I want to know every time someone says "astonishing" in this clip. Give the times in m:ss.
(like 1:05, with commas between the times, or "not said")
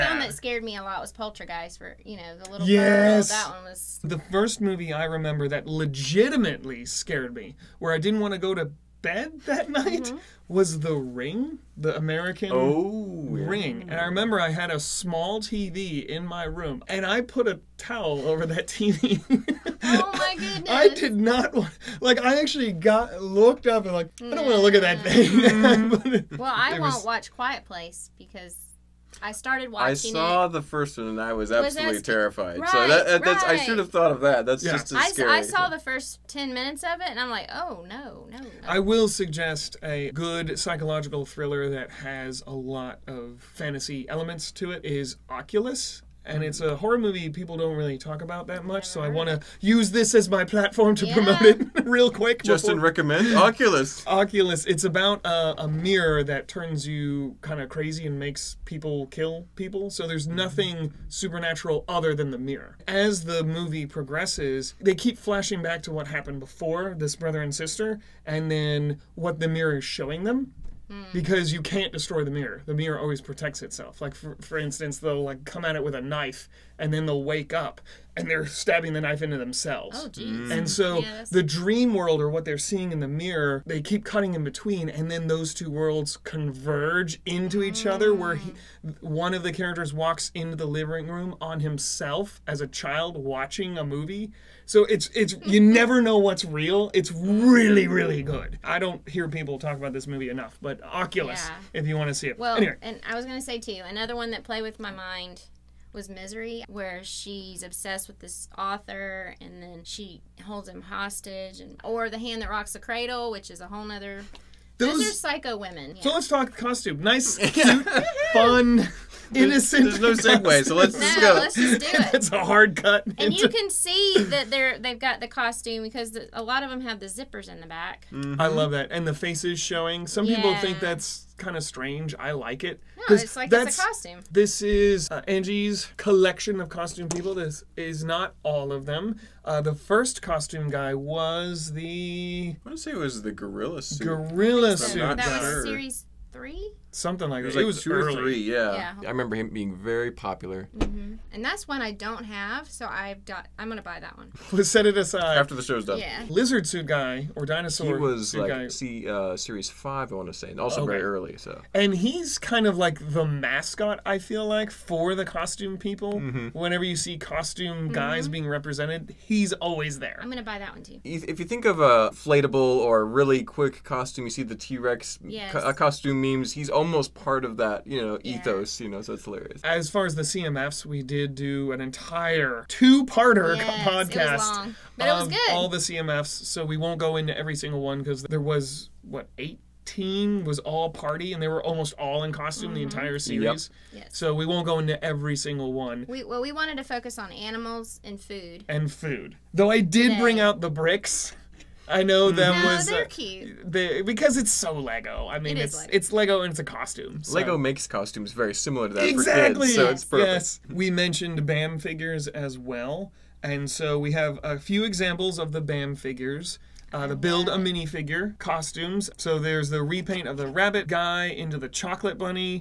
not said.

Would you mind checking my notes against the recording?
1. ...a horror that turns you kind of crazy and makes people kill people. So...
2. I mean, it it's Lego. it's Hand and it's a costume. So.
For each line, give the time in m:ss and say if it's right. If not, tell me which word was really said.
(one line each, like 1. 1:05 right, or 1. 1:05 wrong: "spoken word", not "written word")
1. 0:55 wrong: "mirror", not "horror"
2. 3:25 wrong: "Lego", not "Hand".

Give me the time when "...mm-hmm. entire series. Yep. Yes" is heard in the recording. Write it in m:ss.
3:12.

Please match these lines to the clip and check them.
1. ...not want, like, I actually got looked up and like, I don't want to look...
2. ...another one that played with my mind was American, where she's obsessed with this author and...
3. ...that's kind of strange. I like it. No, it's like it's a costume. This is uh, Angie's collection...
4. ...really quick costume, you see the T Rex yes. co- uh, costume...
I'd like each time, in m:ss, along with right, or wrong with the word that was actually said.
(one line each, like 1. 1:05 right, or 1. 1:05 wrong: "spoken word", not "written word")
1. 0:21 right
2. 1:43 wrong: "Misery", not "American"
3. 2:10 right
4. 2:53 right.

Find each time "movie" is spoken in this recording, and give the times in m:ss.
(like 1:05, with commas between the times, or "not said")
0:04, 0:46, 1:03, 1:33, 1:40.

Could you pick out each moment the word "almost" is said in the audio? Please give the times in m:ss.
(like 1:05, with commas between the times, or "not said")
2:56, 3:11.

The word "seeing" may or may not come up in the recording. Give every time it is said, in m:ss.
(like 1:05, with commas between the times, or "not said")
1:22.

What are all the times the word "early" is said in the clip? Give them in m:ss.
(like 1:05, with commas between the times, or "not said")
2:27, 2:41.